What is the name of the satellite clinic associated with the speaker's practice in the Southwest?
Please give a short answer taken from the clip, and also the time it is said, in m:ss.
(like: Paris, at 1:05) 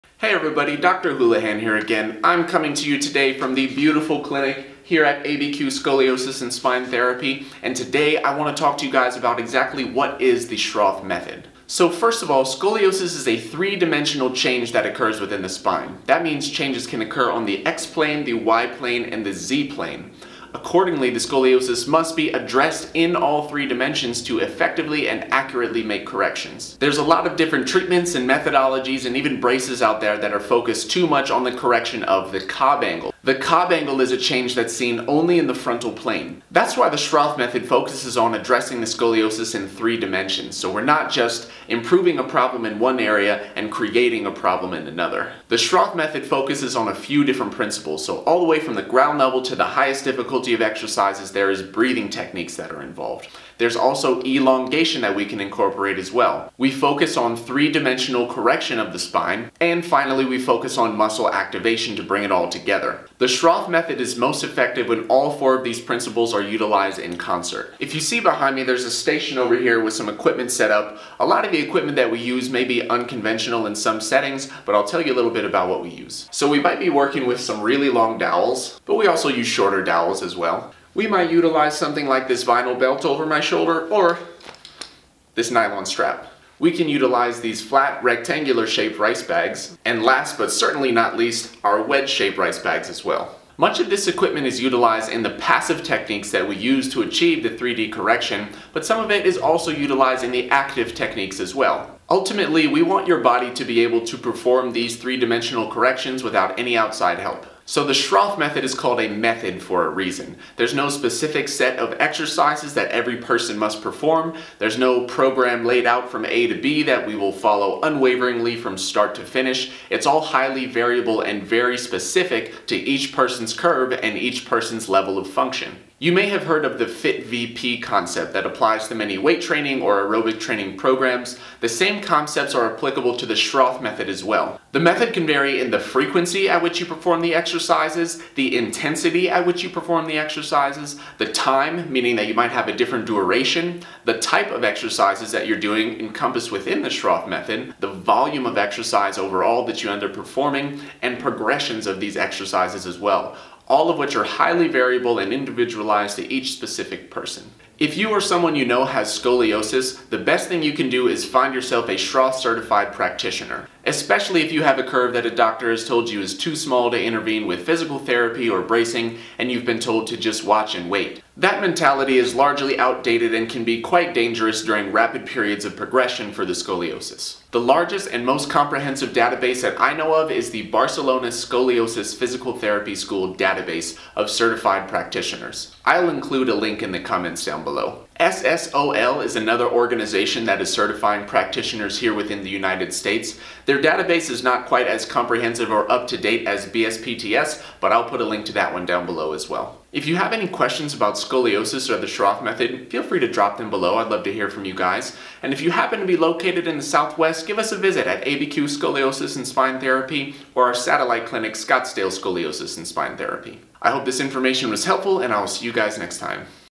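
Scottsdale Scoliosis and Spine Therapy, at 3:31.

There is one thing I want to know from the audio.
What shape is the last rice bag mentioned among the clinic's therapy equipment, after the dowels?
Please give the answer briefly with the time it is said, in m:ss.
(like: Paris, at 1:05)
Wedge shaped, at 1:31.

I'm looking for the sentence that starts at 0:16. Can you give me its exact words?
That means changes can occur on the X-plane, the Y-plane, and the Z-plane.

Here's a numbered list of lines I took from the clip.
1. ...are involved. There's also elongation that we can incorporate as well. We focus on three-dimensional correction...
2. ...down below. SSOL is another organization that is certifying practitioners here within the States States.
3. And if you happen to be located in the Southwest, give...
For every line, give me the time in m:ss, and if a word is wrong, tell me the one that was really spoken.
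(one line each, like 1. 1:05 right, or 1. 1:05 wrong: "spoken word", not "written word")
1. 0:52 right
2. 3:07 wrong: "United", not "States"
3. 3:25 right.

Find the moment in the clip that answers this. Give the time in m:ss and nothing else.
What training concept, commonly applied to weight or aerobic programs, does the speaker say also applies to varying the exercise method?
2:06.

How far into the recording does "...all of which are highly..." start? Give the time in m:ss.
2:33.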